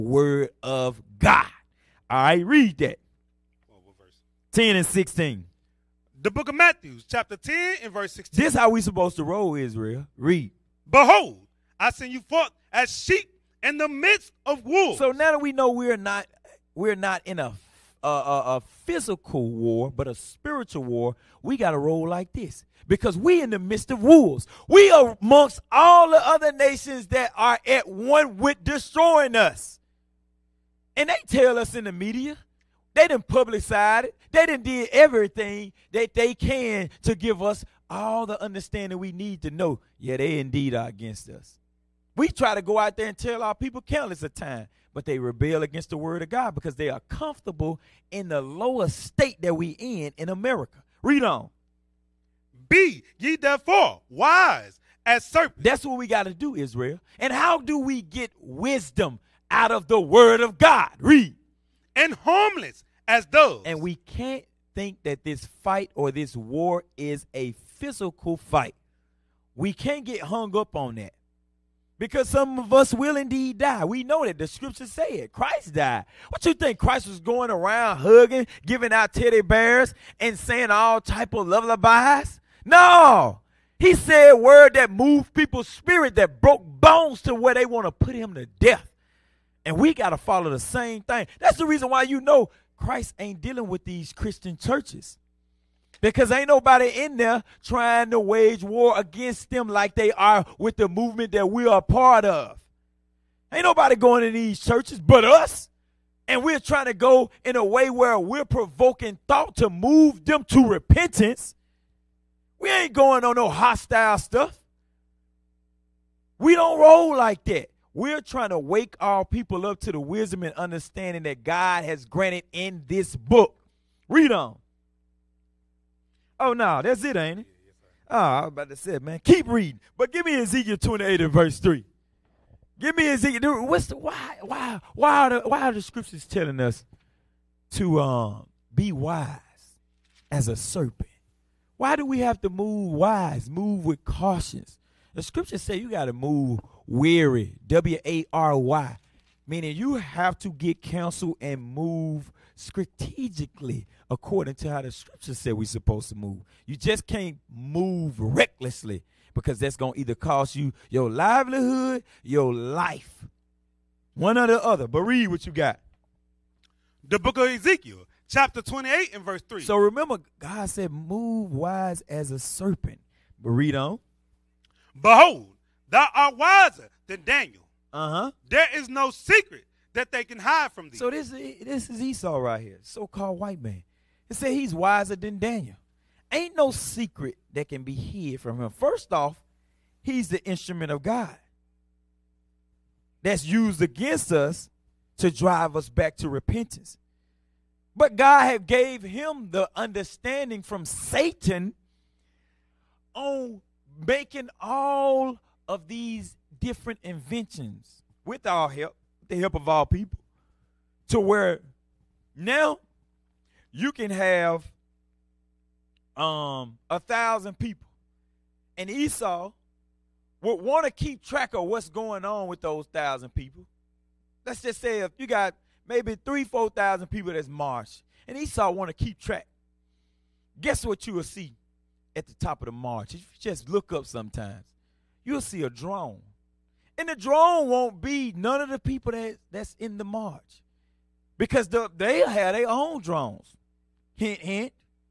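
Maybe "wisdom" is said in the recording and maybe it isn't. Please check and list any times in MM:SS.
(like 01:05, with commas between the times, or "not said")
00:58, 01:59.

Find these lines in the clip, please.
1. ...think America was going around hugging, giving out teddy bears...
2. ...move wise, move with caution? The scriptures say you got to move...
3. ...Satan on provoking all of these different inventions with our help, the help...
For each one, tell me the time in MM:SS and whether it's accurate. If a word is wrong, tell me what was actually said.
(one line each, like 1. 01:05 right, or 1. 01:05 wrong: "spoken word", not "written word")
1. 01:16 wrong: "Christ", not "America"
2. 02:22 right
3. 03:20 wrong: "making", not "provoking".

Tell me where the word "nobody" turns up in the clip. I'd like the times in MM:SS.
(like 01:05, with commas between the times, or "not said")
01:36, 01:43.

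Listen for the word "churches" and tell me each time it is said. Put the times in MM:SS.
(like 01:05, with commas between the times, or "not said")
01:34, 01:44.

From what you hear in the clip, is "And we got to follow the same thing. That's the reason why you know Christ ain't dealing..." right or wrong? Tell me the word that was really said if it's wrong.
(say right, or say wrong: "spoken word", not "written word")
right.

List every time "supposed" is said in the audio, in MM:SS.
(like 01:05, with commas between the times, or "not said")
00:08, 02:35.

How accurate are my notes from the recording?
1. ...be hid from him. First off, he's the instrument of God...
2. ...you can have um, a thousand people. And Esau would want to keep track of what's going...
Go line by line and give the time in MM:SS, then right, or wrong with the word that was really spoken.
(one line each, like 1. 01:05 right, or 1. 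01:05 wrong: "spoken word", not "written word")
1. 03:07 right
2. 03:33 right.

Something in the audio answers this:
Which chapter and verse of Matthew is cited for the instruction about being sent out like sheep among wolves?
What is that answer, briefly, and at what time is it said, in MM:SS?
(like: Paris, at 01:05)
Chapter 10, verse 16, at 00:07.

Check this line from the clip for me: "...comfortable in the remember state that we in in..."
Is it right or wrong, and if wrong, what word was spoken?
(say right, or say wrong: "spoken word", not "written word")
wrong: "lower", not "remember".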